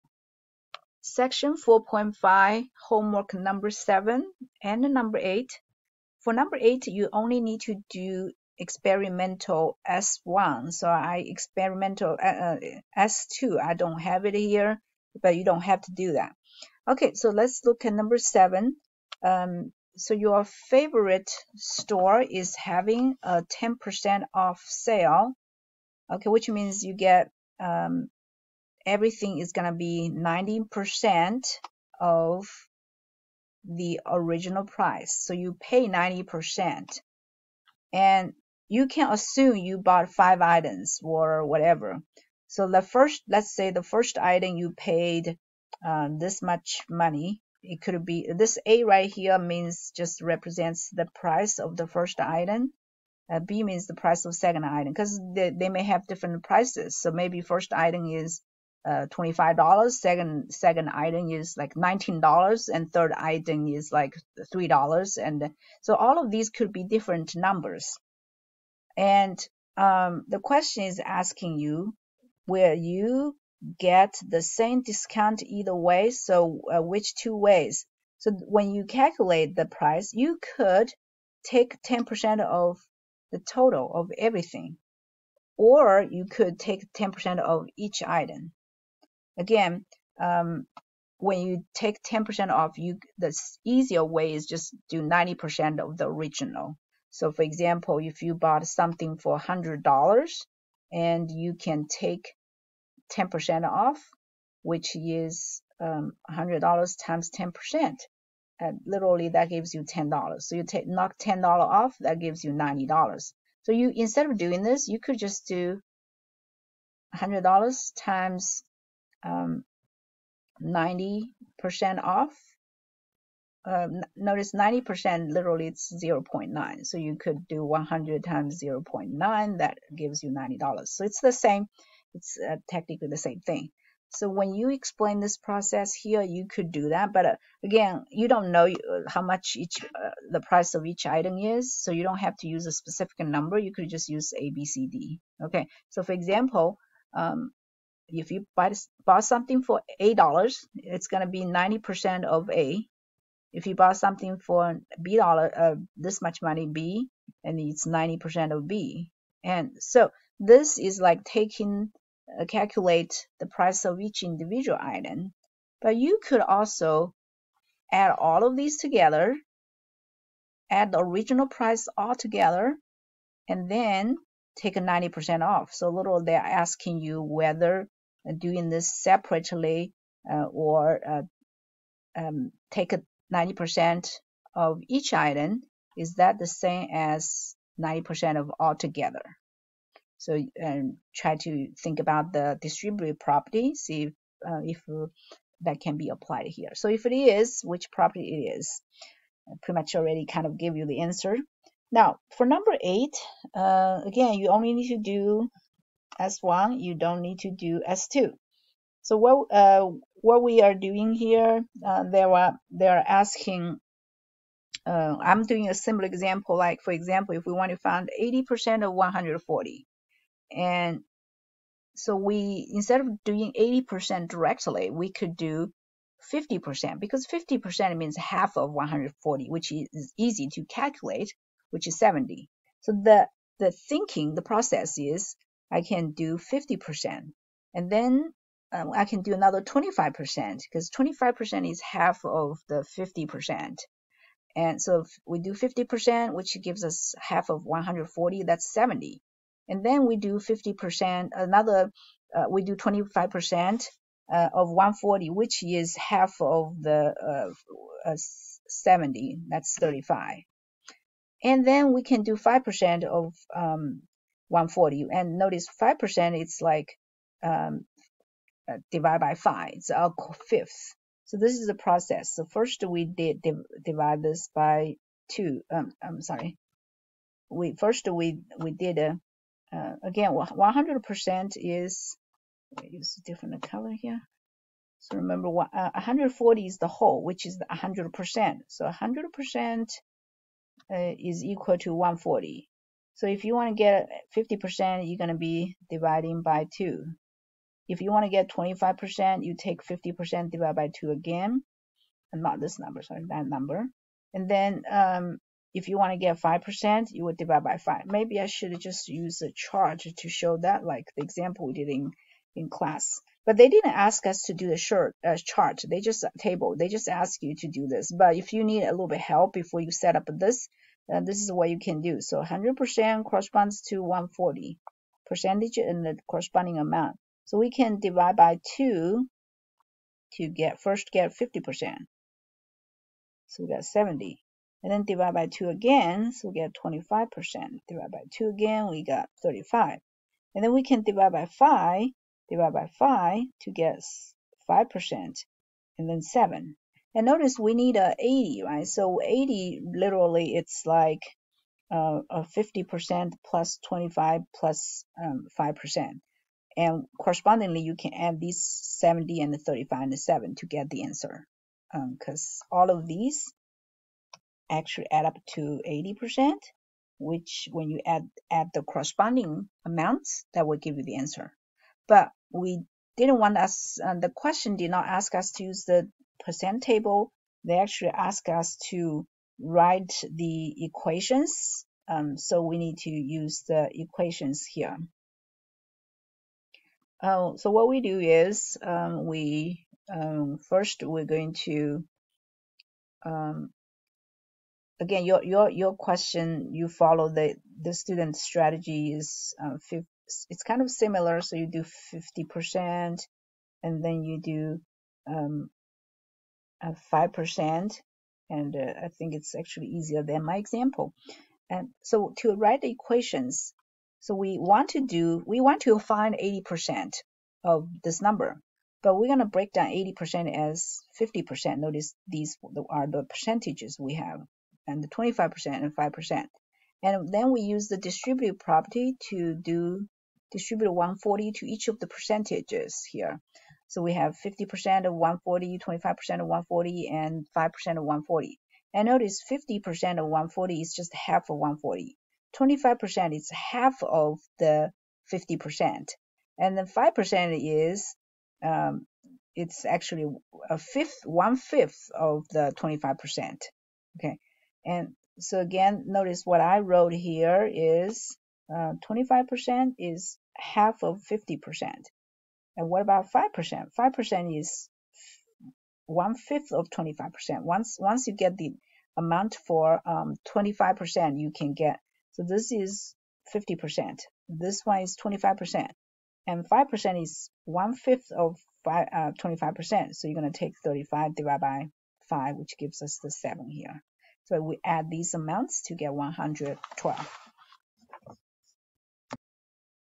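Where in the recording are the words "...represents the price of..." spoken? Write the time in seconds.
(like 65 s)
50 s.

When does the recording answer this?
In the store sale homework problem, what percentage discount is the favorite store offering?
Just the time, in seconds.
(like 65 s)
23 s.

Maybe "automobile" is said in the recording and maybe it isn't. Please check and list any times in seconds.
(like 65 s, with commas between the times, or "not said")
not said.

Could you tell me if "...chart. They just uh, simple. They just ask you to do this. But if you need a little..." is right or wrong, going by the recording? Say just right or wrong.
wrong.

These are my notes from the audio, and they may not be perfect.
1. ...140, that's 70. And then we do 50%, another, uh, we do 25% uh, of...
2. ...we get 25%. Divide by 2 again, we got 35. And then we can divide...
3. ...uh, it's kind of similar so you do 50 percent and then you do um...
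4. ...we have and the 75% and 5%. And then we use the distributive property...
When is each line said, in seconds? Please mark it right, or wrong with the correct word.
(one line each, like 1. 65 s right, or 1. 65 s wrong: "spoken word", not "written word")
1. 247 s right
2. 336 s right
3. 399 s right
4. 423 s wrong: "25", not "75".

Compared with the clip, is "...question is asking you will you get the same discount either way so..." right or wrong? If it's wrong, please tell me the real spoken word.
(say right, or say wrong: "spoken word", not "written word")
right.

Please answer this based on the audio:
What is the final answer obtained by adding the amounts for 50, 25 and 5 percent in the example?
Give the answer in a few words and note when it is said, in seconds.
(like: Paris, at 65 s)
112, at 486 s.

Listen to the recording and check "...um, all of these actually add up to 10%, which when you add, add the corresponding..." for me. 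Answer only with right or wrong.
wrong.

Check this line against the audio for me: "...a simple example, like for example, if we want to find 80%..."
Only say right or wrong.
right.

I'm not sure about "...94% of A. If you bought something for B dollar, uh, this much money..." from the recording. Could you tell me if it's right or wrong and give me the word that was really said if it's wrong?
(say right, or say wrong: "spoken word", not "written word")
wrong: "90", not "94".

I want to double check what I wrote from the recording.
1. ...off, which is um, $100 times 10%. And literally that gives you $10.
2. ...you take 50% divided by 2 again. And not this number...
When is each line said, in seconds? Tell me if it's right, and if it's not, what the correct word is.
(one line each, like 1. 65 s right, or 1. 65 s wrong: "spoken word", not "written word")
1. 103 s right
2. 299 s right.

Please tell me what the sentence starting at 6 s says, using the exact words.
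For number 8, you only need to do experimental S1.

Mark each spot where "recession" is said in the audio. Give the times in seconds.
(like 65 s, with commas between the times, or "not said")
not said.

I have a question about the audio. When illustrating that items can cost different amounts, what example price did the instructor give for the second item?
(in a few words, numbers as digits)
$19.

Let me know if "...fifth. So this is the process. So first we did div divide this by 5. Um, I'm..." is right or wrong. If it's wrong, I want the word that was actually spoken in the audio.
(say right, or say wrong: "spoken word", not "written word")
wrong: "2", not "5".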